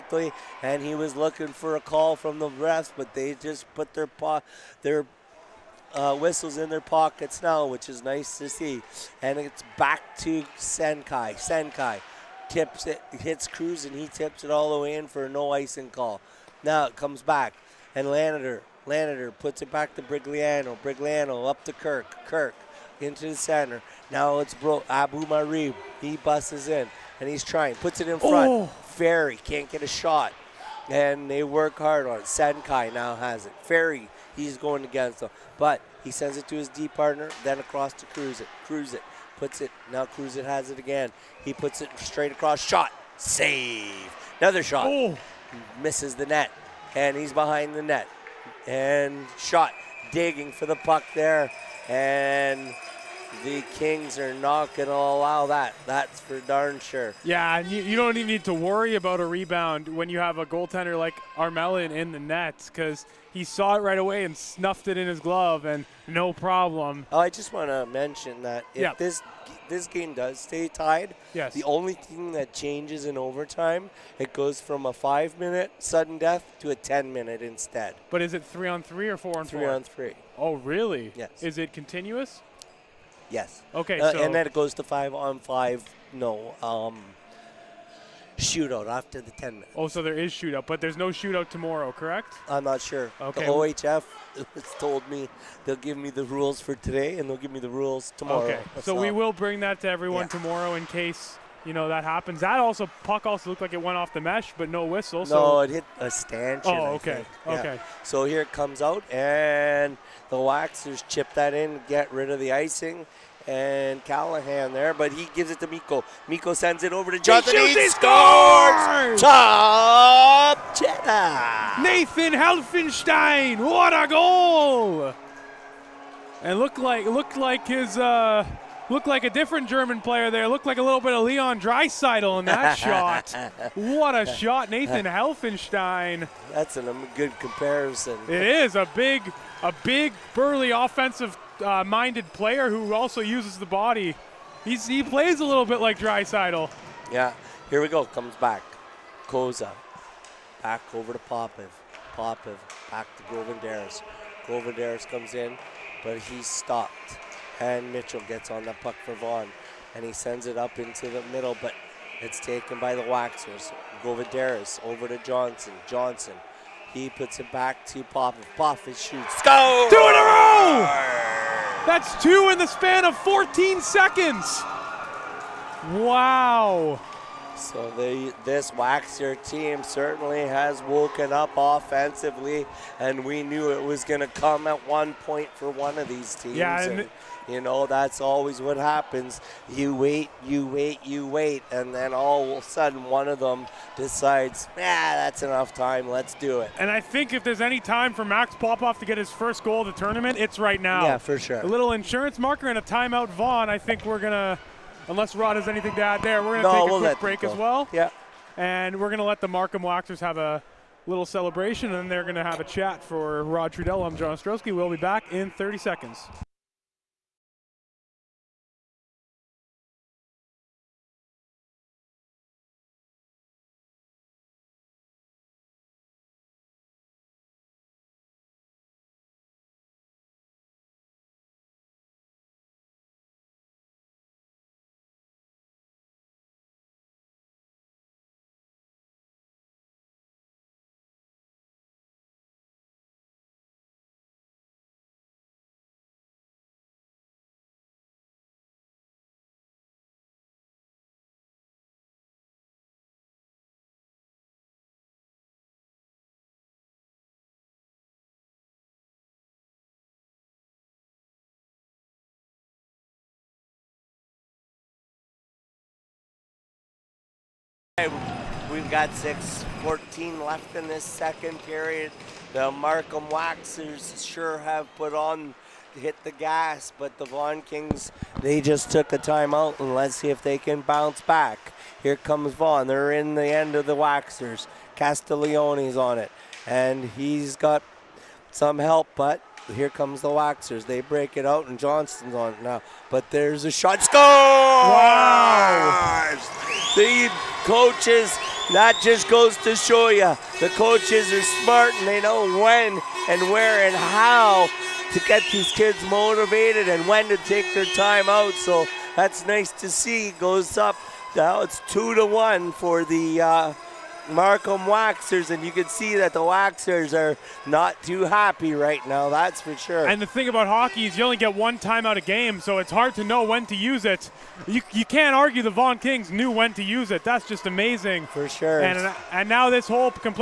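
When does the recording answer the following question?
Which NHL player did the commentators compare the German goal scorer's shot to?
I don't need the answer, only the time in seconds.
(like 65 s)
131 s.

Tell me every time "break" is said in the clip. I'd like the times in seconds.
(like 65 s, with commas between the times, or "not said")
207 s, 291 s.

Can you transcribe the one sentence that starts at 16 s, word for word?
Now it comes back, and Lanader Lanader puts it back to Brigliano.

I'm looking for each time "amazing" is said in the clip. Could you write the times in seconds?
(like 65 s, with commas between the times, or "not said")
327 s.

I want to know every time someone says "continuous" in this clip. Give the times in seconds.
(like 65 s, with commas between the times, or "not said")
81 s.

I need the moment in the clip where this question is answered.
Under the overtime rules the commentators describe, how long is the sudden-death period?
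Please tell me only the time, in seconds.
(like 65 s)
76 s.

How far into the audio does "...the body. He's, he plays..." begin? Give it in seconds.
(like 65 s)
143 s.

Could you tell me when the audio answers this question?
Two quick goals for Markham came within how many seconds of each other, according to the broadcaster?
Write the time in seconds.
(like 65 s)
173 s.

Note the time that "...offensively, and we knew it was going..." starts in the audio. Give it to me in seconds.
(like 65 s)
181 s.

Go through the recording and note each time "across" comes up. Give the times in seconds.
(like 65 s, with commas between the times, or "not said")
37 s, 42 s.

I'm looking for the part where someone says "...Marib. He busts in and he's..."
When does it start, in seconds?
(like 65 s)
25 s.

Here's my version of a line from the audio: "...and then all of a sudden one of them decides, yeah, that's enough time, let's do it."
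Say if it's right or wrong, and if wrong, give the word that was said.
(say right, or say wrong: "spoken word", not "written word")
right.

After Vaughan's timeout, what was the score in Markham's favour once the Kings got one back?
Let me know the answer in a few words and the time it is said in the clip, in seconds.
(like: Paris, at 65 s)
2-1, at 311 s.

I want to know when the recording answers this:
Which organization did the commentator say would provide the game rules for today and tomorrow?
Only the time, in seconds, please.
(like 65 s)
93 s.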